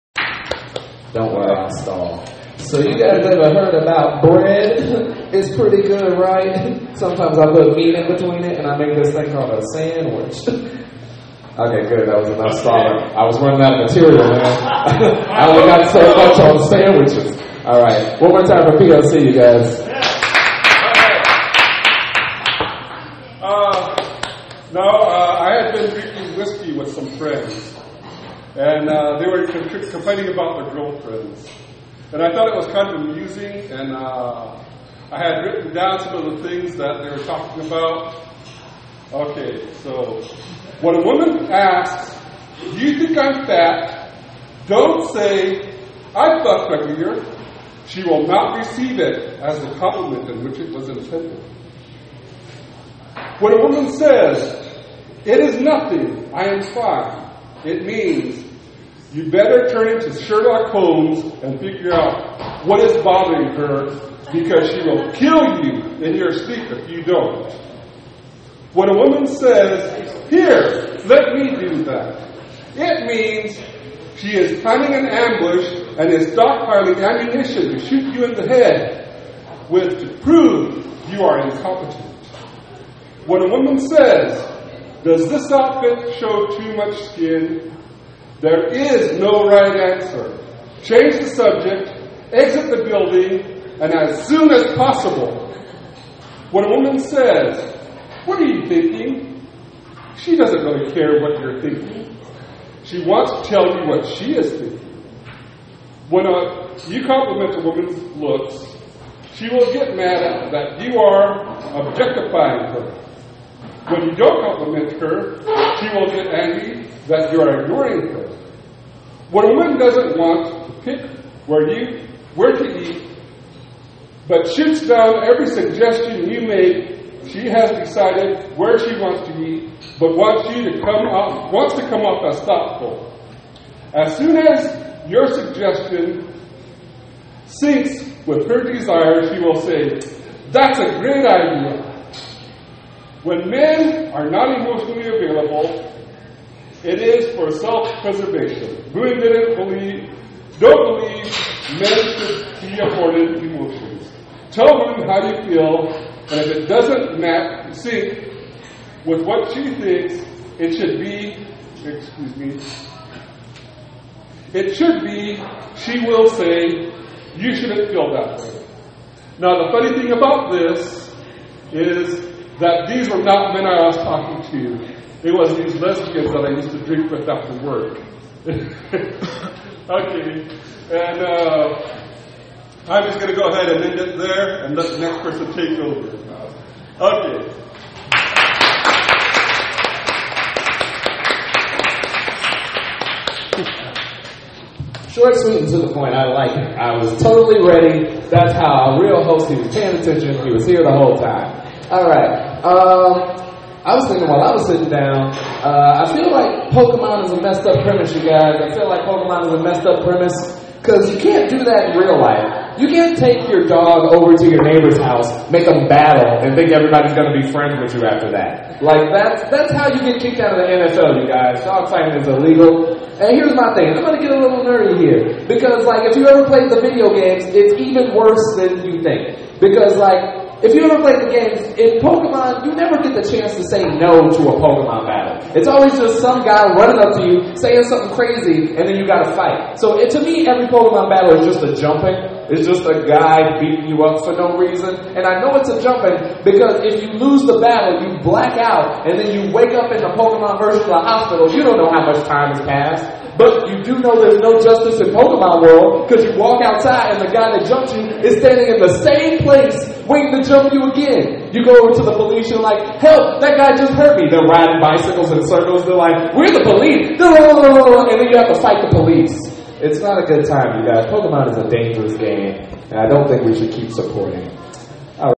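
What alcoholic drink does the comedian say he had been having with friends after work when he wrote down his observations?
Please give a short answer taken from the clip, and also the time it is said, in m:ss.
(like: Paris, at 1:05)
whiskey, at 0:26.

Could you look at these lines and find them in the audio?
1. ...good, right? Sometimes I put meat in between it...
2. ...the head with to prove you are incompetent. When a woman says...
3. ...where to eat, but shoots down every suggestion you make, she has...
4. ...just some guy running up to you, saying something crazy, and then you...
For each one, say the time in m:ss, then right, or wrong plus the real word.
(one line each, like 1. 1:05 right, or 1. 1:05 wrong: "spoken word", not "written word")
1. 0:05 right
2. 1:18 right
3. 2:02 right
4. 3:55 right.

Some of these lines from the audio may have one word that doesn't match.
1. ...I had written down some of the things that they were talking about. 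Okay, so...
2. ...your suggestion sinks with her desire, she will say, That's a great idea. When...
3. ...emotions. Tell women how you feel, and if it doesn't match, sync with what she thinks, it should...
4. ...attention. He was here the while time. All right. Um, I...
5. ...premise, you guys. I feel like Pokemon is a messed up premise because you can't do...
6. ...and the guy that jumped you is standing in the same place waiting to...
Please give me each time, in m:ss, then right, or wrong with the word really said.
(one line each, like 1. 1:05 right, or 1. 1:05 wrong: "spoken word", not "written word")
1. 0:35 right
2. 2:15 right
3. 2:33 right
4. 3:19 wrong: "whole", not "while"
5. 3:27 right
6. 4:17 right.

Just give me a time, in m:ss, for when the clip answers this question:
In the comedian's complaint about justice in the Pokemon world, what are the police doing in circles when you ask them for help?
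4:24.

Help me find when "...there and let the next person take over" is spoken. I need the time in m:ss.
3:04.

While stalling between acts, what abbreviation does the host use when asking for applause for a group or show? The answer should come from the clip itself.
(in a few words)
PLC.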